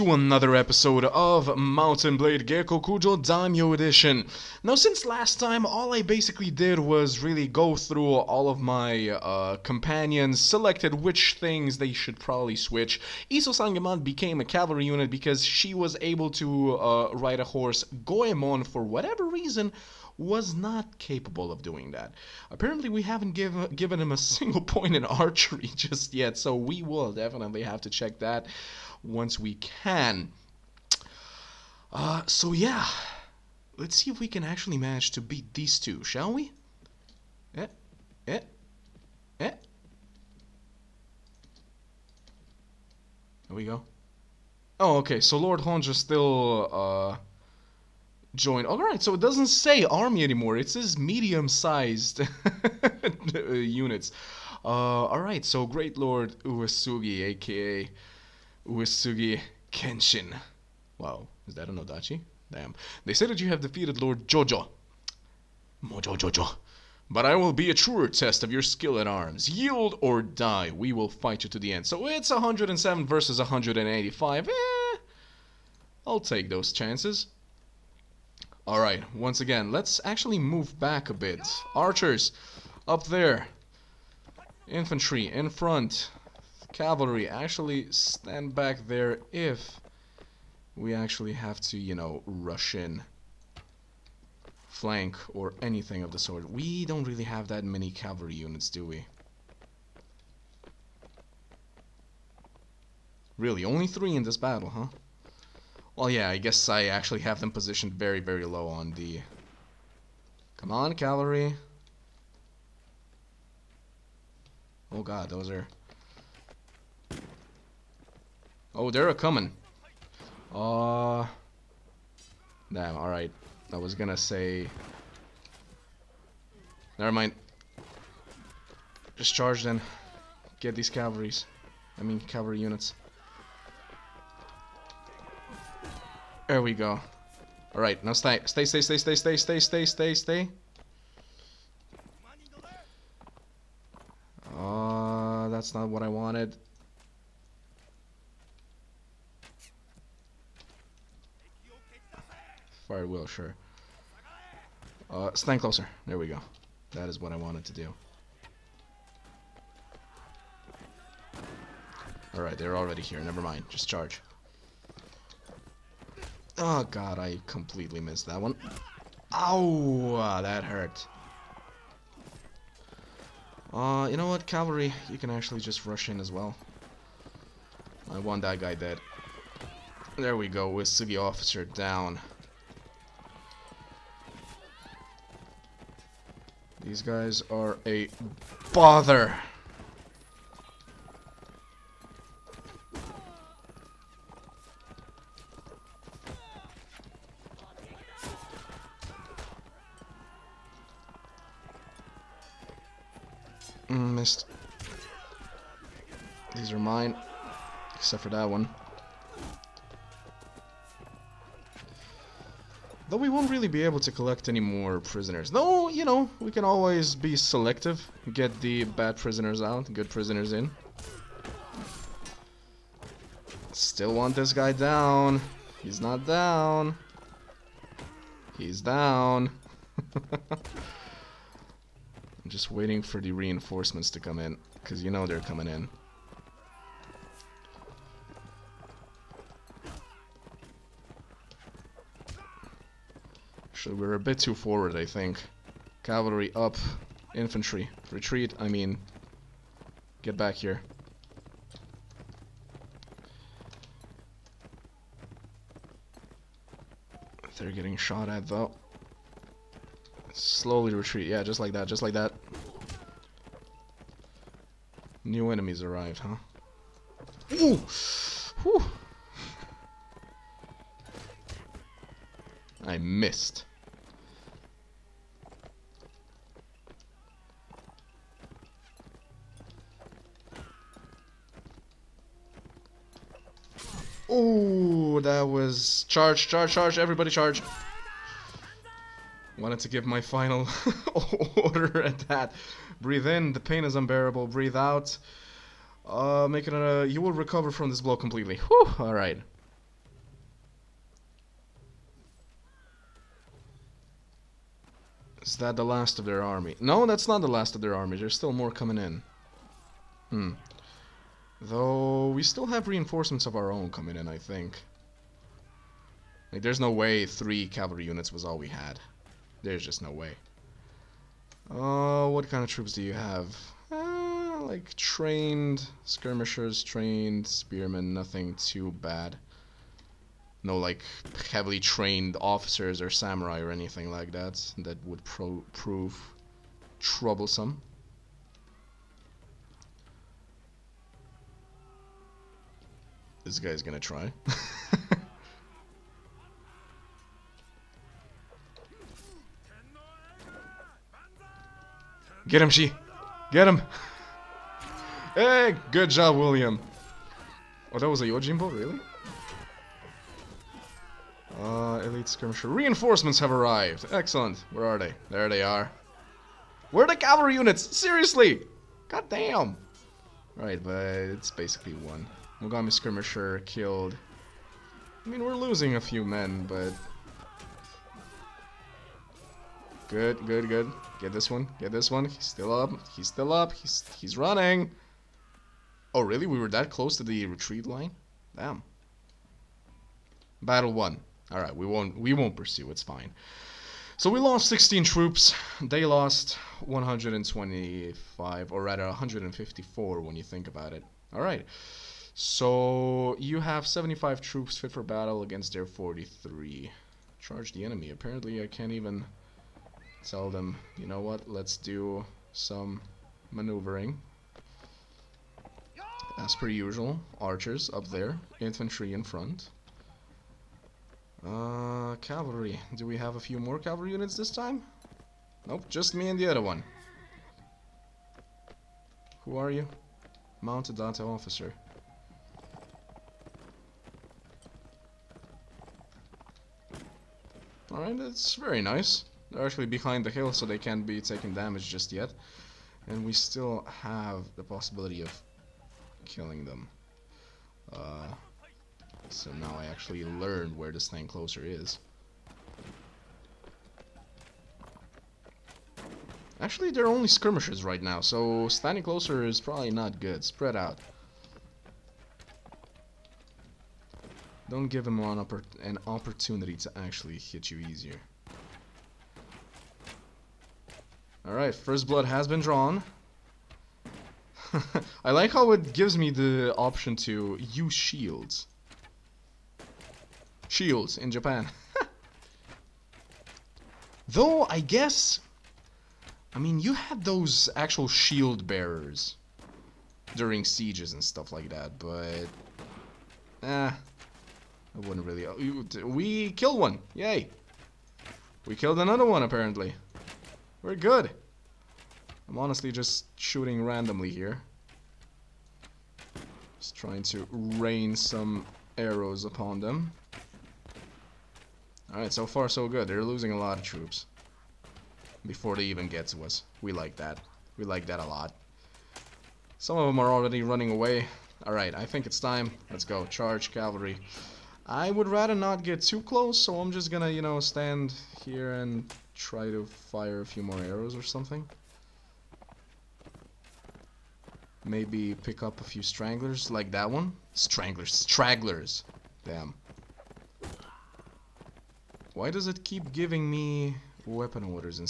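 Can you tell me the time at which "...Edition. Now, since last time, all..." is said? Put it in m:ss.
0:03.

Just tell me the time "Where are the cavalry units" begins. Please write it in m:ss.
6:06.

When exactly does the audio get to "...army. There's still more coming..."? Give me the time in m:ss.
5:07.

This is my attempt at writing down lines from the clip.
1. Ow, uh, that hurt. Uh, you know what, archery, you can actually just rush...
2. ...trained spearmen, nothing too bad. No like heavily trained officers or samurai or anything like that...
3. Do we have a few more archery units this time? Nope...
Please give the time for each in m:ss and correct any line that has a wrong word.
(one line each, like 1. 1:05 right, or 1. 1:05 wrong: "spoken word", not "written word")
1. 2:49 wrong: "cavalry", not "archery"
2. 5:26 right
3. 7:02 wrong: "cavalry", not "archery".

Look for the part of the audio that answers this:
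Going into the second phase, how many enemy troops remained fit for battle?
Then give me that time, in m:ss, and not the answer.
6:45.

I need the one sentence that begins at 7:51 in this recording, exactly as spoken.
Alright, first blood has been drawn.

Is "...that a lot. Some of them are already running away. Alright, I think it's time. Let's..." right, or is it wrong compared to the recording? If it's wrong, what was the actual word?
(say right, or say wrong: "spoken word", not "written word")
right.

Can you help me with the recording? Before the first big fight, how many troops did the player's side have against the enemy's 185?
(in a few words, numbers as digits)
107.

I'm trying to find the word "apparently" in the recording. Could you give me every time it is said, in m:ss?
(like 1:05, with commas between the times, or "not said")
0:22, 6:48, 8:19.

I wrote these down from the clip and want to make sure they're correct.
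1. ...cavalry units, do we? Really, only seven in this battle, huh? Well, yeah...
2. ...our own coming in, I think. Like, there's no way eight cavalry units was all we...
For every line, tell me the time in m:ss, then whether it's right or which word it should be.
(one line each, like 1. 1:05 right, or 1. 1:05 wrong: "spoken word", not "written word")
1. 1:37 wrong: "three", not "seven"
2. 5:13 wrong: "three", not "eight".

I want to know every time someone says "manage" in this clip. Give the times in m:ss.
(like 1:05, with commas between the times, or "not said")
0:34.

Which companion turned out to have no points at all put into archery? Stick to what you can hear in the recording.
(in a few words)
Goemon.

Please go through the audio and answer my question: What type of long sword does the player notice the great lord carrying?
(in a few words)
Odachi.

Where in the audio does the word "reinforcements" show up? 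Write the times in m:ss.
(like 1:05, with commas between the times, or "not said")
3:53, 5:12, 6:02.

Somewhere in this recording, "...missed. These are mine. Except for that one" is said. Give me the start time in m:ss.
3:24.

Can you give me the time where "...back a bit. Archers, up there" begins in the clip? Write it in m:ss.
1:20.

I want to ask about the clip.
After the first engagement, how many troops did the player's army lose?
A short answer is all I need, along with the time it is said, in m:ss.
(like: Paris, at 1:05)
16, at 6:34.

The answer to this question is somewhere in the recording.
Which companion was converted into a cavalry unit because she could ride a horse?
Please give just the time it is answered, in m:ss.
0:13.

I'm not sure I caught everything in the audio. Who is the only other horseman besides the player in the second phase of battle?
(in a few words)
Mounted Date officer.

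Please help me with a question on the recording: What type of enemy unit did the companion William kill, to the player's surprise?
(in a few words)
Yojimbo.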